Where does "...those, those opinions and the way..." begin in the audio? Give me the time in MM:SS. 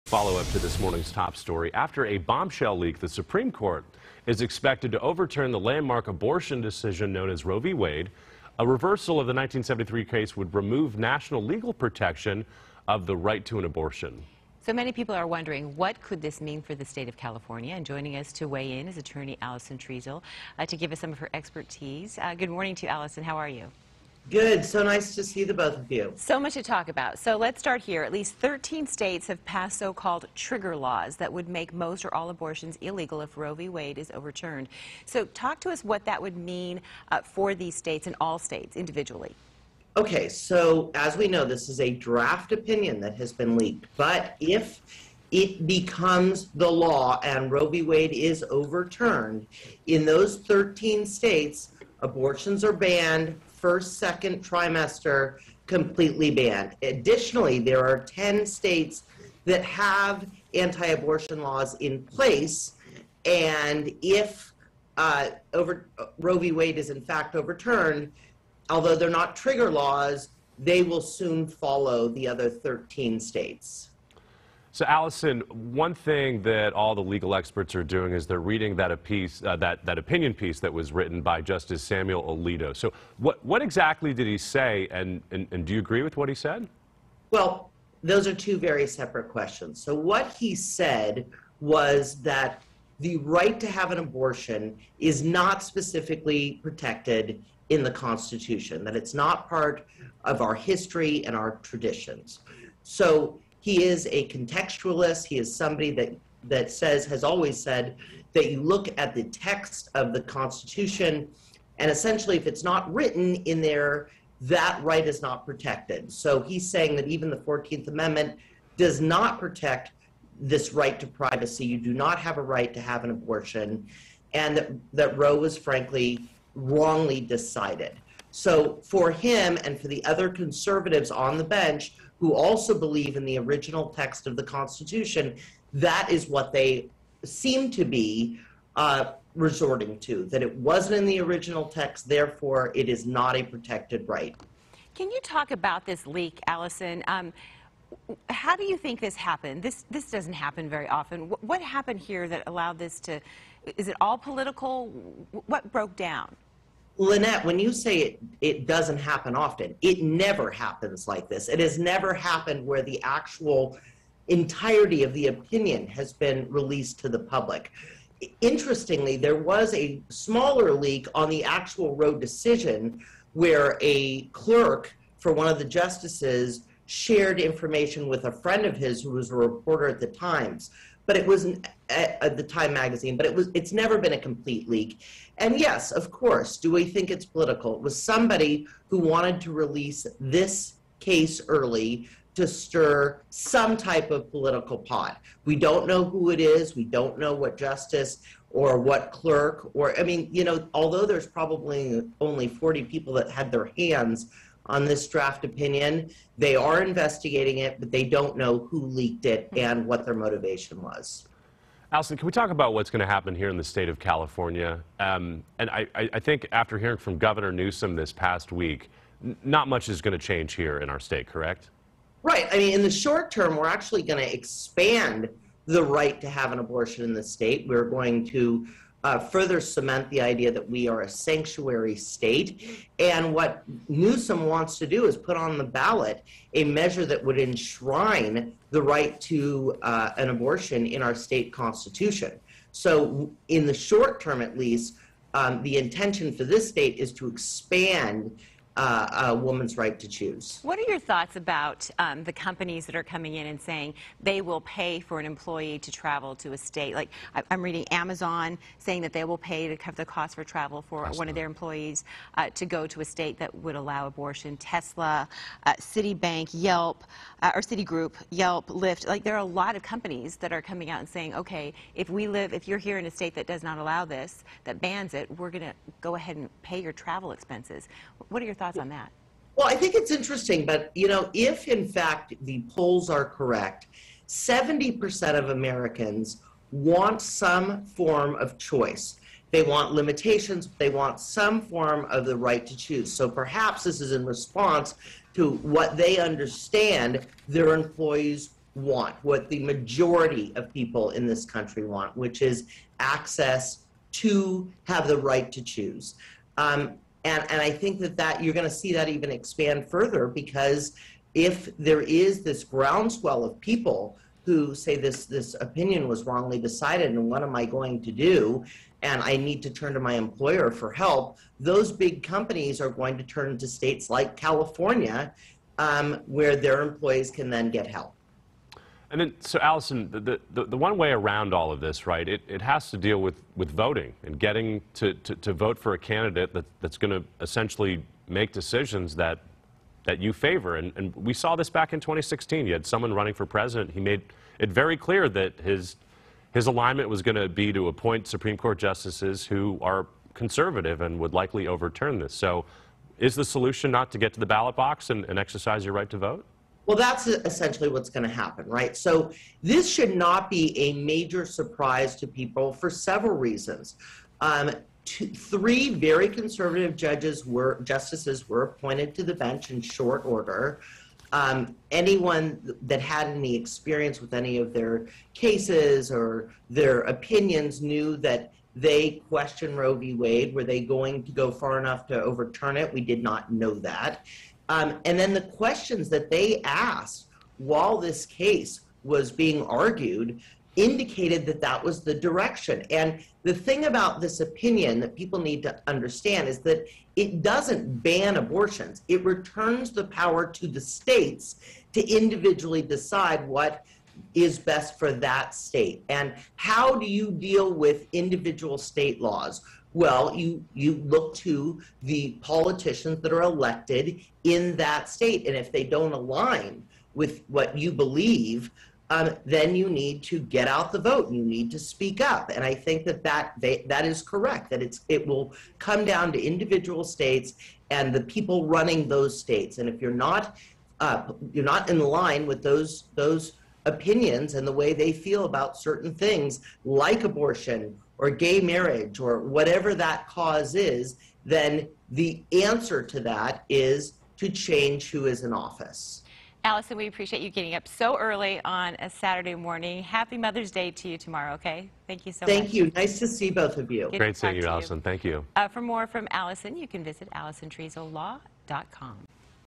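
07:12.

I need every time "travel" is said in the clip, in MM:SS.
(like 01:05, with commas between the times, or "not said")
04:15, 04:20, 04:36.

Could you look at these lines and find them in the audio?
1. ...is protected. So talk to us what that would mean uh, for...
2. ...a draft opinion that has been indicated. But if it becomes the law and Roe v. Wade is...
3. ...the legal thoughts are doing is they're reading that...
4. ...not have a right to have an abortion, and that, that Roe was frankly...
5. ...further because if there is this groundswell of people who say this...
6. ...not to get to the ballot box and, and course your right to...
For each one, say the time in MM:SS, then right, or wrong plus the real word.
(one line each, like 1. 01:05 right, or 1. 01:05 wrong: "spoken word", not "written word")
1. 00:33 wrong: "overturned", not "protected"
2. 00:41 wrong: "leaked", not "indicated"
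3. 01:16 wrong: "experts", not "thoughts"
4. 02:01 right
5. 05:09 right
6. 05:53 wrong: "exercise", not "course".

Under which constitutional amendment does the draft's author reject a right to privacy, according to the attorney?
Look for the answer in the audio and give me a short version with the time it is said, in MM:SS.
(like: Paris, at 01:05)
14th Amendment, at 01:57.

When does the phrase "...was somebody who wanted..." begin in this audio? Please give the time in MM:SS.
03:07.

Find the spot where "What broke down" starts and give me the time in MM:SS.
02:35.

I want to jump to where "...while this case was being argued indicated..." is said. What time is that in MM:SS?
06:27.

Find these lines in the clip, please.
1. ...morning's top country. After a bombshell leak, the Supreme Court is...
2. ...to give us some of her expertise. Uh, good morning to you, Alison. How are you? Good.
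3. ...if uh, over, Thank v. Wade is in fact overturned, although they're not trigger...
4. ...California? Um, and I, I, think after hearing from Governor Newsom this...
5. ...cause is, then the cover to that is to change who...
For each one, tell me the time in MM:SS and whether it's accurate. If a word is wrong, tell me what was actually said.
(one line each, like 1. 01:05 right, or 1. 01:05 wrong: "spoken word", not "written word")
1. 00:00 wrong: "story", not "country"
2. 00:20 right
3. 01:04 wrong: "Roe", not "Thank"
4. 03:33 right
5. 07:20 wrong: "answer", not "cover".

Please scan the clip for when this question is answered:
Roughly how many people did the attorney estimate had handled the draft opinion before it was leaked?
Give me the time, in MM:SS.
03:22.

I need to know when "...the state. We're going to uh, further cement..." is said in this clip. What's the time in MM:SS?
03:47.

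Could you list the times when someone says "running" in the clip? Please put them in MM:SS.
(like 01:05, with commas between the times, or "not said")
05:43, 07:08.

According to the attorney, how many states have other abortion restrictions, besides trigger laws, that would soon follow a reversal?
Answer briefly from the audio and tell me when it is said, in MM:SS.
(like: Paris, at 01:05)
10, at 00:57.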